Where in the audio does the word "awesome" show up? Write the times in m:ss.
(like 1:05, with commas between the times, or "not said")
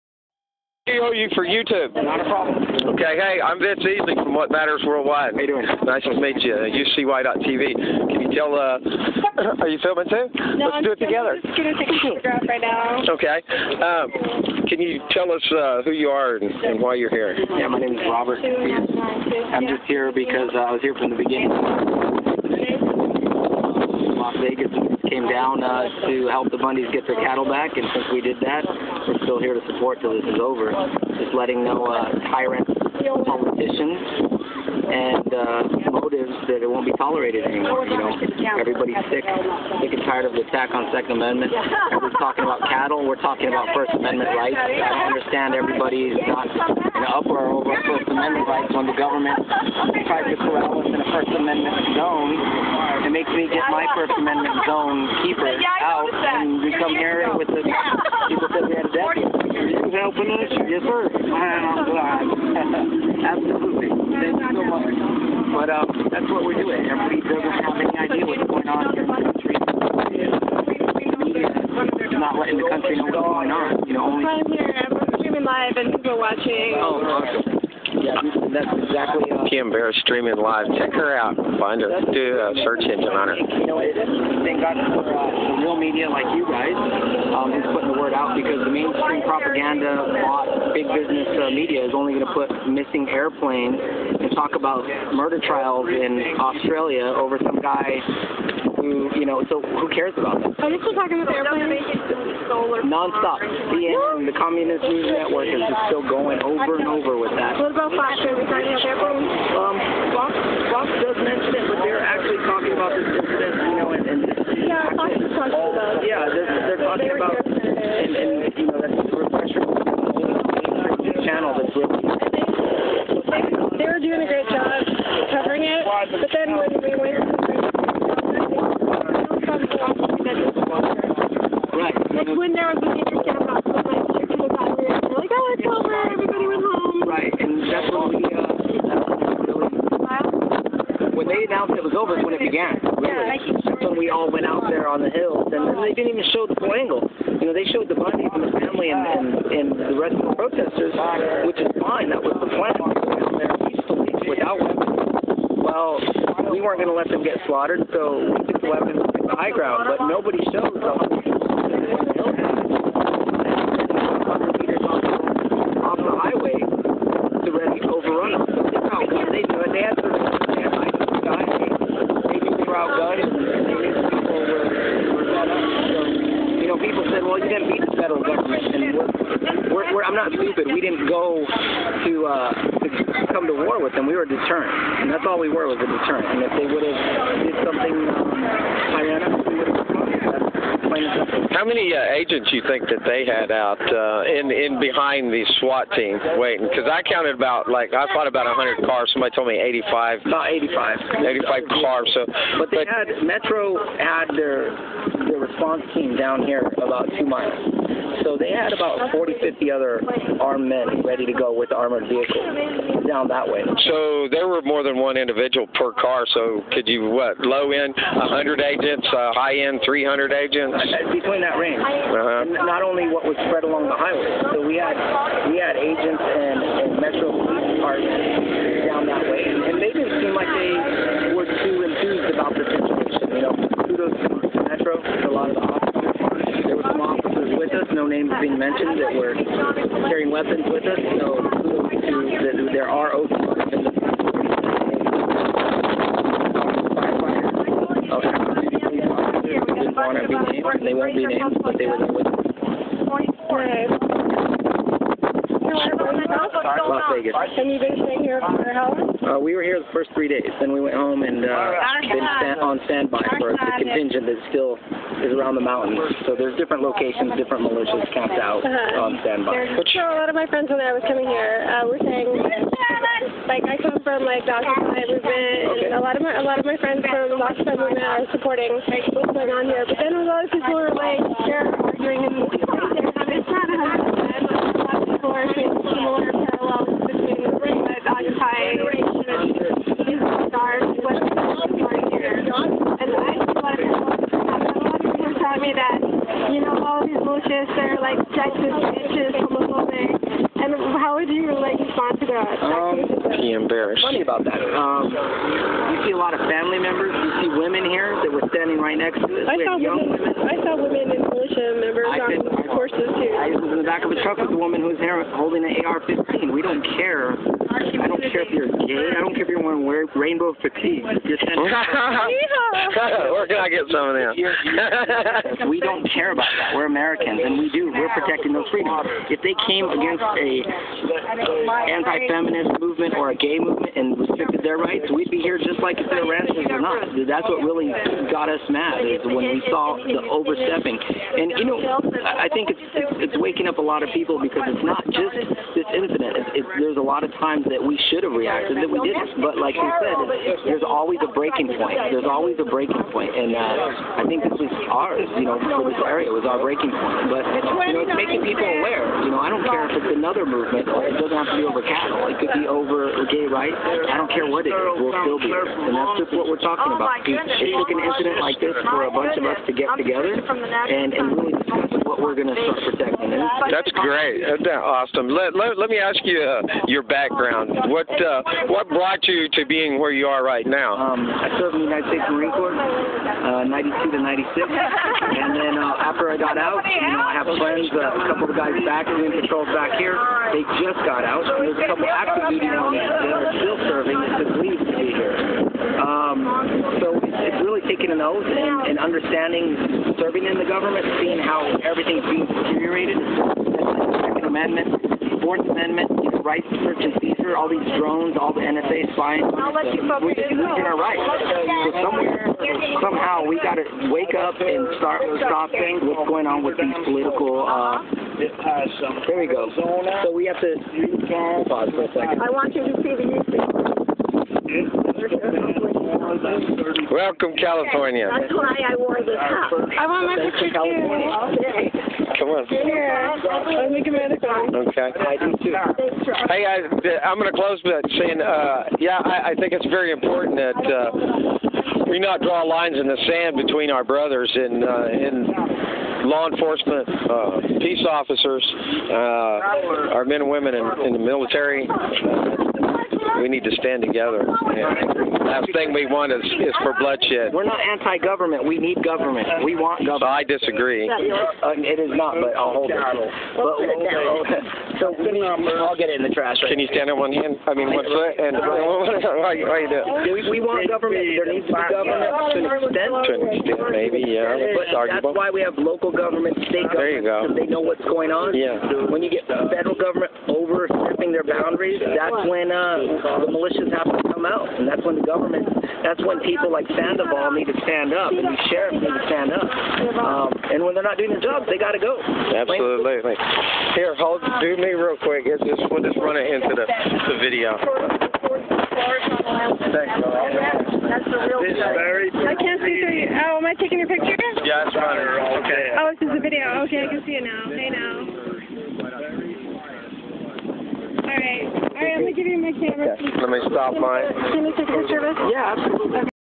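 1:17, 6:14.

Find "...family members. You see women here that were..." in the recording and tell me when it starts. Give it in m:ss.
5:06.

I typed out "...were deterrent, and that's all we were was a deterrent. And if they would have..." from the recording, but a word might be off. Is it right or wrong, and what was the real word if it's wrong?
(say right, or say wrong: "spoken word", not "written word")
right.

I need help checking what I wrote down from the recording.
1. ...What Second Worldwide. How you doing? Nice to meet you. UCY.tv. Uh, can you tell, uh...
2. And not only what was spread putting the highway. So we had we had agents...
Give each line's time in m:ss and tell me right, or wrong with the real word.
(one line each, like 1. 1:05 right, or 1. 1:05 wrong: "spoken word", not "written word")
1. 0:04 wrong: "Matters", not "Second"
2. 3:42 wrong: "along", not "putting".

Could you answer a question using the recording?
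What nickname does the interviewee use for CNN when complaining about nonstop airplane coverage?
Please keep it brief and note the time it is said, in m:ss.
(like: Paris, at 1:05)
Communist News Network, at 1:44.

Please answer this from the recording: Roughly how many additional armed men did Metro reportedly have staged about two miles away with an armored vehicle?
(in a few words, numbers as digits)
40 to 50.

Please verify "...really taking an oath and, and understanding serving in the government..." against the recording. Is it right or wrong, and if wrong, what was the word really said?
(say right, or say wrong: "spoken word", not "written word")
right.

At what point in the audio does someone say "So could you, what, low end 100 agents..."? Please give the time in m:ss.
3:36.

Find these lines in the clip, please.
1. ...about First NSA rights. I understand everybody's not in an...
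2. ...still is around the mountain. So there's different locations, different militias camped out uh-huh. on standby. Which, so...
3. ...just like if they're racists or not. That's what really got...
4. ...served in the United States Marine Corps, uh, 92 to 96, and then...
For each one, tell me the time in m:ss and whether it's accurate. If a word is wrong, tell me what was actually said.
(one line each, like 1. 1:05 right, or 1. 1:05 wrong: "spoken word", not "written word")
1. 0:43 wrong: "Amendment", not "NSA"
2. 4:24 right
3. 5:35 right
4. 6:21 right.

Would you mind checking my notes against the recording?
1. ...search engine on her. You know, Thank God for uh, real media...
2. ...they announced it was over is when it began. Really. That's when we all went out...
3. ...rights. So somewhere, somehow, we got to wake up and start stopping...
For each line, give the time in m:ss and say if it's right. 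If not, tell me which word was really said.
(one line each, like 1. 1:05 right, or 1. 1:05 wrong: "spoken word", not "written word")
1. 1:22 right
2. 2:21 right
3. 6:50 right.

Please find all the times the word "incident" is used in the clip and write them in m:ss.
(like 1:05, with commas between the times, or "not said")
1:53, 5:45, 6:08.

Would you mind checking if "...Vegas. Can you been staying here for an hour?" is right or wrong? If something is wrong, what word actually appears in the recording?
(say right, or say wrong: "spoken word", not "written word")
right.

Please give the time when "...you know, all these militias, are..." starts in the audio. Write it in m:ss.
4:56.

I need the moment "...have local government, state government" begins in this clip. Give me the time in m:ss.
7:55.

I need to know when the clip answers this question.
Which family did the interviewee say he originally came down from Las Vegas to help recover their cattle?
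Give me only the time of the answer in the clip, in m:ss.
0:26.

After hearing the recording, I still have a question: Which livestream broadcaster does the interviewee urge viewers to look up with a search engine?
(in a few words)
Kim Barrett.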